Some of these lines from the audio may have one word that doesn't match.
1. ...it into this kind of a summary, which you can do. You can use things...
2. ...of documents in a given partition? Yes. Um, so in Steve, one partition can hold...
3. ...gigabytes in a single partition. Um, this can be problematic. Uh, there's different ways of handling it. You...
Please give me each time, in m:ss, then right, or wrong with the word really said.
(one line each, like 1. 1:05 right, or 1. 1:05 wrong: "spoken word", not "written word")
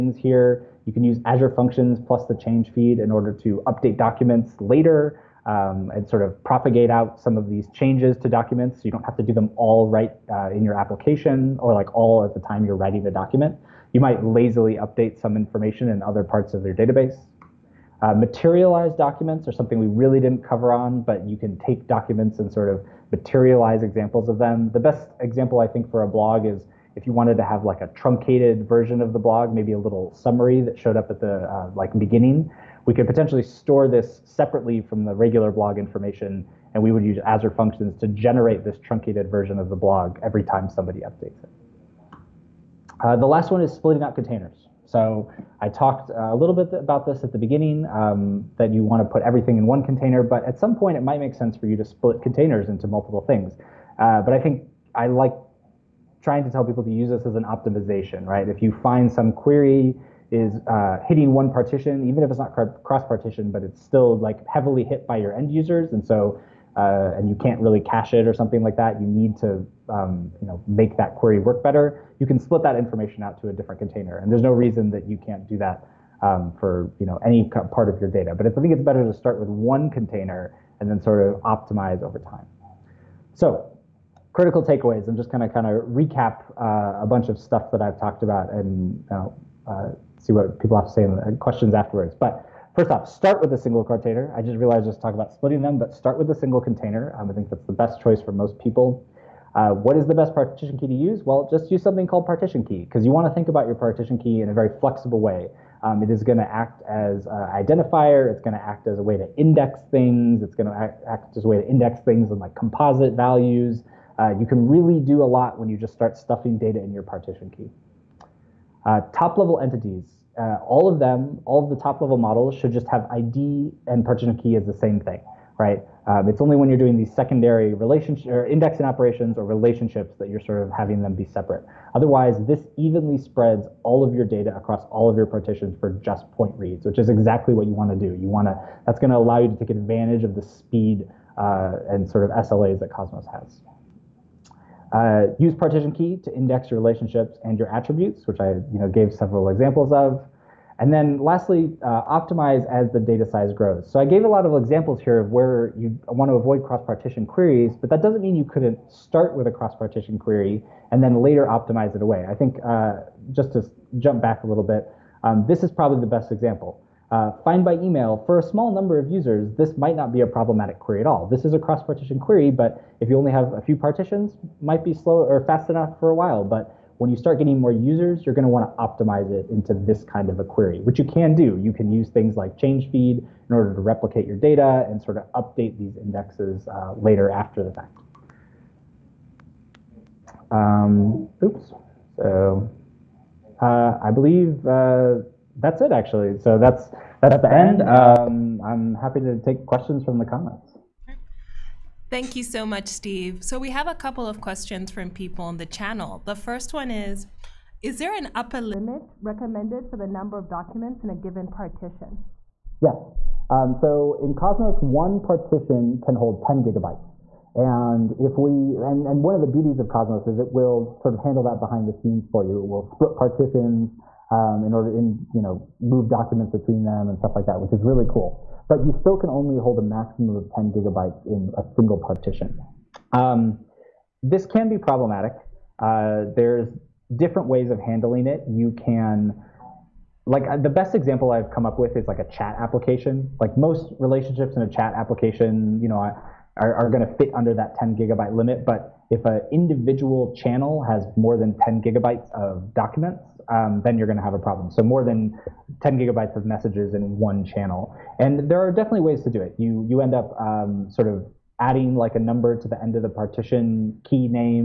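1. 2:59 wrong: "query", not "summary"
2. 3:30 wrong: "Cosmos", not "Steve"
3. 3:50 right.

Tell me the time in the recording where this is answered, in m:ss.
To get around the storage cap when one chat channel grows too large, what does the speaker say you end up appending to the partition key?
4:22.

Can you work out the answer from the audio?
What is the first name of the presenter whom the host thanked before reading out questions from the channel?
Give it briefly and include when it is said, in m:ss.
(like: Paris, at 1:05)
Steve, at 3:22.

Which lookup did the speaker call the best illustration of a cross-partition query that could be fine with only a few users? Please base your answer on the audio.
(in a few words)
find by email.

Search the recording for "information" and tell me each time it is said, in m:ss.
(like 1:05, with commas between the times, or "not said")
0:15, 0:35, 1:12.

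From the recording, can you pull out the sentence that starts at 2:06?
Um, it's only when you're doing these secondary relationship or indexing operations or relationships that you're sort of having them be separate.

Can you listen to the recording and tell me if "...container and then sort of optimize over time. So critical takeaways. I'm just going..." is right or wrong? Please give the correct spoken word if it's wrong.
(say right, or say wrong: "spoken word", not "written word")
right.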